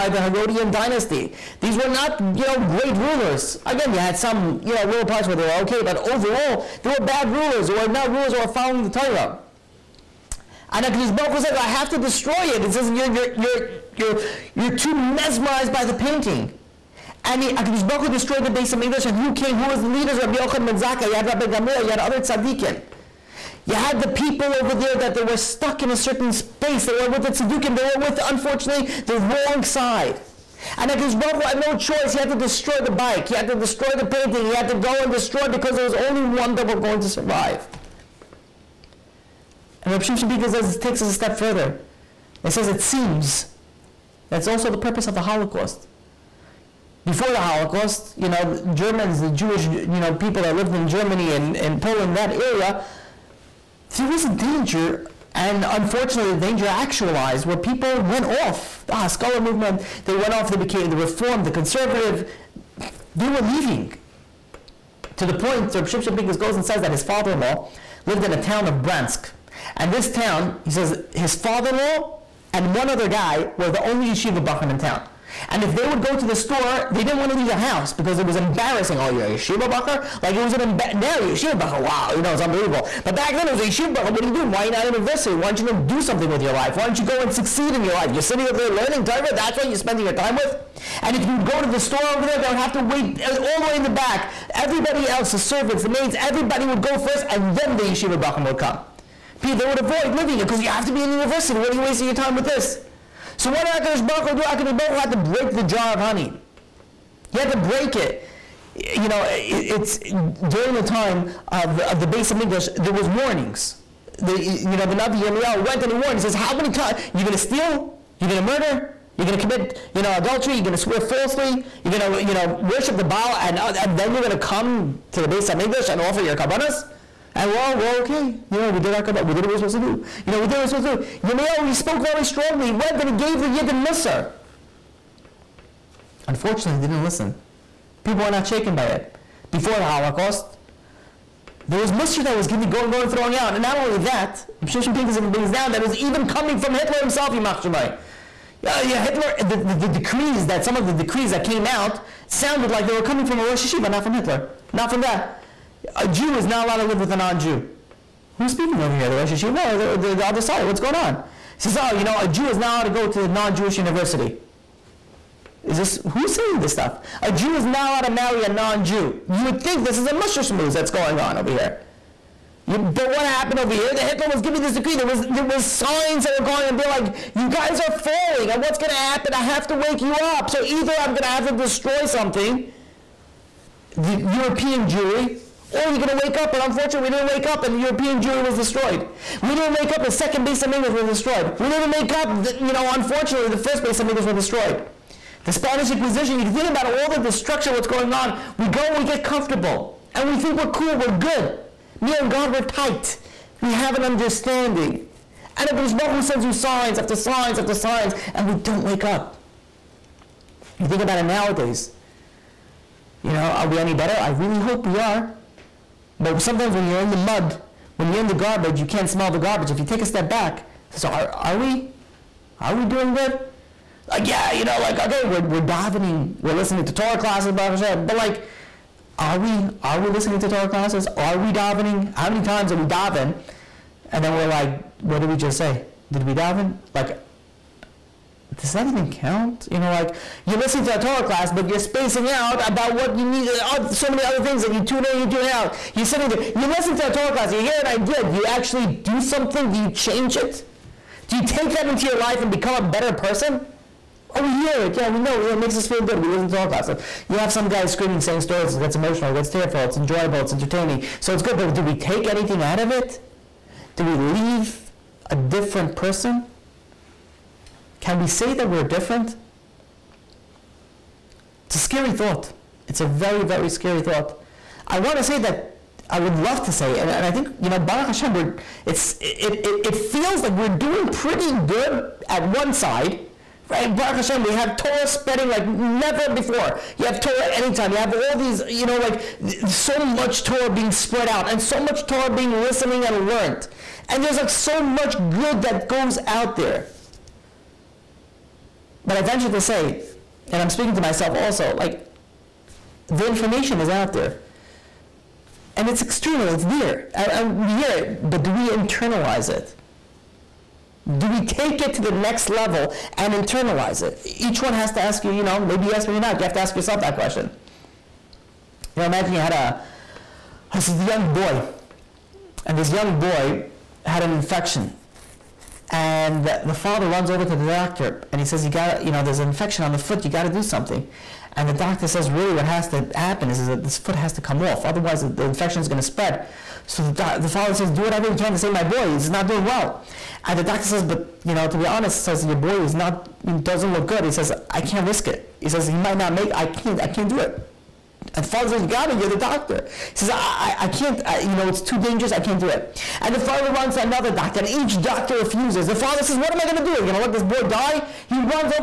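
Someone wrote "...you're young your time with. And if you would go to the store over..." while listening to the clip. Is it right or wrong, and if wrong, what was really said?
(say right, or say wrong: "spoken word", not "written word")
wrong: "spending", not "young".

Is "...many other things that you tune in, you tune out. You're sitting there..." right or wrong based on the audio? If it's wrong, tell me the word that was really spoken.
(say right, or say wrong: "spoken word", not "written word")
right.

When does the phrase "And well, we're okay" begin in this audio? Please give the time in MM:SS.
02:07.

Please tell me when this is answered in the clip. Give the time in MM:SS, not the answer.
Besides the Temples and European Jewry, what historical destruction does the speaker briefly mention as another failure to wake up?
03:15.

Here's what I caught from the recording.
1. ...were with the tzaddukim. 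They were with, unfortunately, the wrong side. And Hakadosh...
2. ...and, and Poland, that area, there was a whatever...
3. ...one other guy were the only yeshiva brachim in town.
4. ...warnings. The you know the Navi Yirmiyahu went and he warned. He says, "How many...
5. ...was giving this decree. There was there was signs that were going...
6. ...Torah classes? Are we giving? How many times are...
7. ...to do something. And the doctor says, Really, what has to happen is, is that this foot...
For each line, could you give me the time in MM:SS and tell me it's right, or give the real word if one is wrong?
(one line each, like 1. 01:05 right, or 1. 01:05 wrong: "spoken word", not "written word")
1. 00:26 right
2. 00:51 wrong: "danger", not "whatever"
3. 01:12 wrong: "bachim", not "brachim"
4. 01:53 right
5. 02:54 right
6. 03:50 wrong: "davening", not "giving"
7. 05:30 right.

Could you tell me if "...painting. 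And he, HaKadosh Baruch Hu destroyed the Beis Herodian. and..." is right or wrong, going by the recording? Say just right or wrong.
wrong.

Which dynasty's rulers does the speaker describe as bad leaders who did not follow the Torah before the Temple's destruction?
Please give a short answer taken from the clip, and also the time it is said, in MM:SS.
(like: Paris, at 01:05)
Herodian dynasty, at 00:00.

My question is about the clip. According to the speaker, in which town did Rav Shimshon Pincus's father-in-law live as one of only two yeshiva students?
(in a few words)
Bransk.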